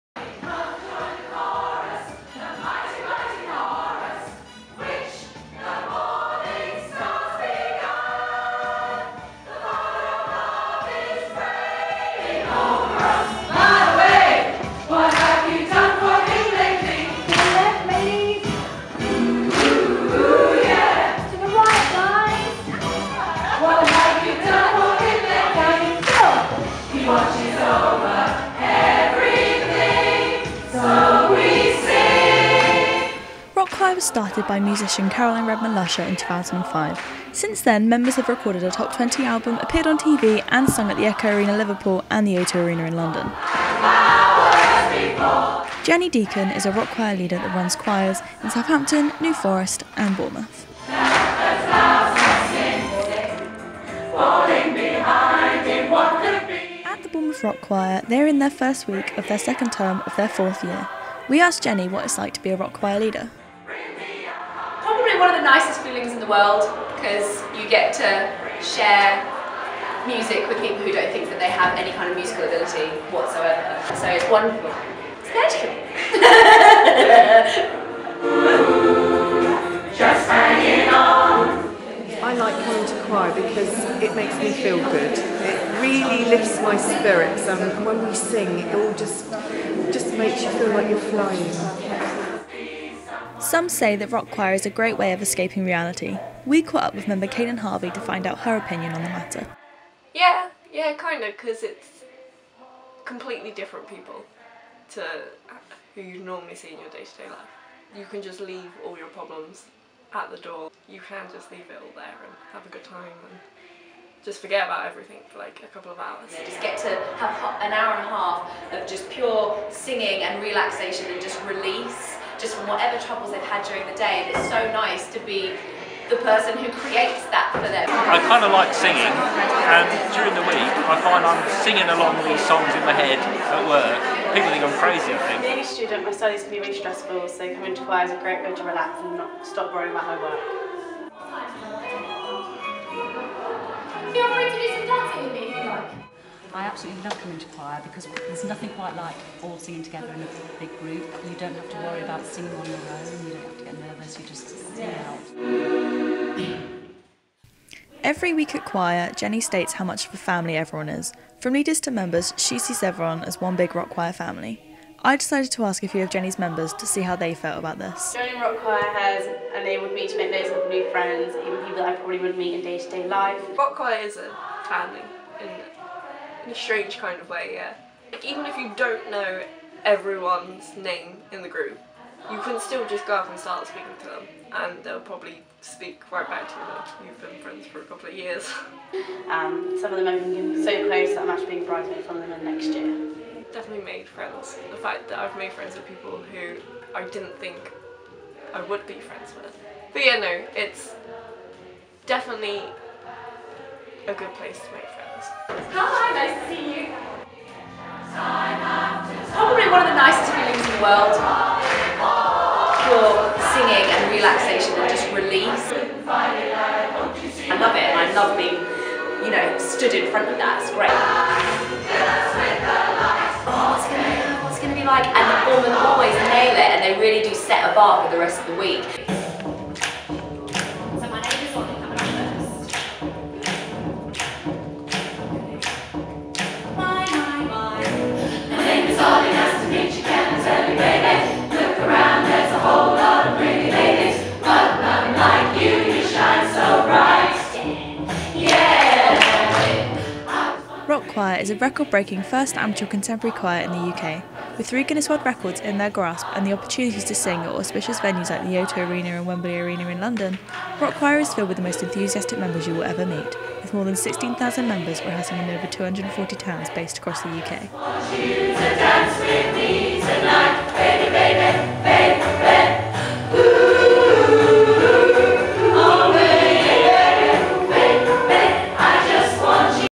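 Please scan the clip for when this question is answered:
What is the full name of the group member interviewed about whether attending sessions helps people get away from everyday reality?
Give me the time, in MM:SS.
01:37.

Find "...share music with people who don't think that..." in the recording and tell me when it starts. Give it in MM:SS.
01:08.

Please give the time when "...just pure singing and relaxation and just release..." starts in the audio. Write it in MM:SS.
01:58.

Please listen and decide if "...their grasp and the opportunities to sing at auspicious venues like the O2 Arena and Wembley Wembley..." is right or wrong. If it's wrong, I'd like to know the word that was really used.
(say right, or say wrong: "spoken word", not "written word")
wrong: "Arena", not "Wembley".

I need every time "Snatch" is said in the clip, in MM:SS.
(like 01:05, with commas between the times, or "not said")
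not said.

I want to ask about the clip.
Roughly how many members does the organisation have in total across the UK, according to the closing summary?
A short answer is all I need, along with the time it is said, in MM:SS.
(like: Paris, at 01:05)
16,000, at 04:23.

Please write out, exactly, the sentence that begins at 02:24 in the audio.
Feel free to do I absolutely love coming to choir because there's nothing quite like all singing together in a big group.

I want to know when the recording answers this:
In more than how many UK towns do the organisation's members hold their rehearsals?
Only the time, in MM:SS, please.
04:25.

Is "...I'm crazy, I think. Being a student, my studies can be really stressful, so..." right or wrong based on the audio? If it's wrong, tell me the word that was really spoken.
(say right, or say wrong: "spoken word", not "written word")
right.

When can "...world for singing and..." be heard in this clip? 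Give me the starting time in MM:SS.
03:30.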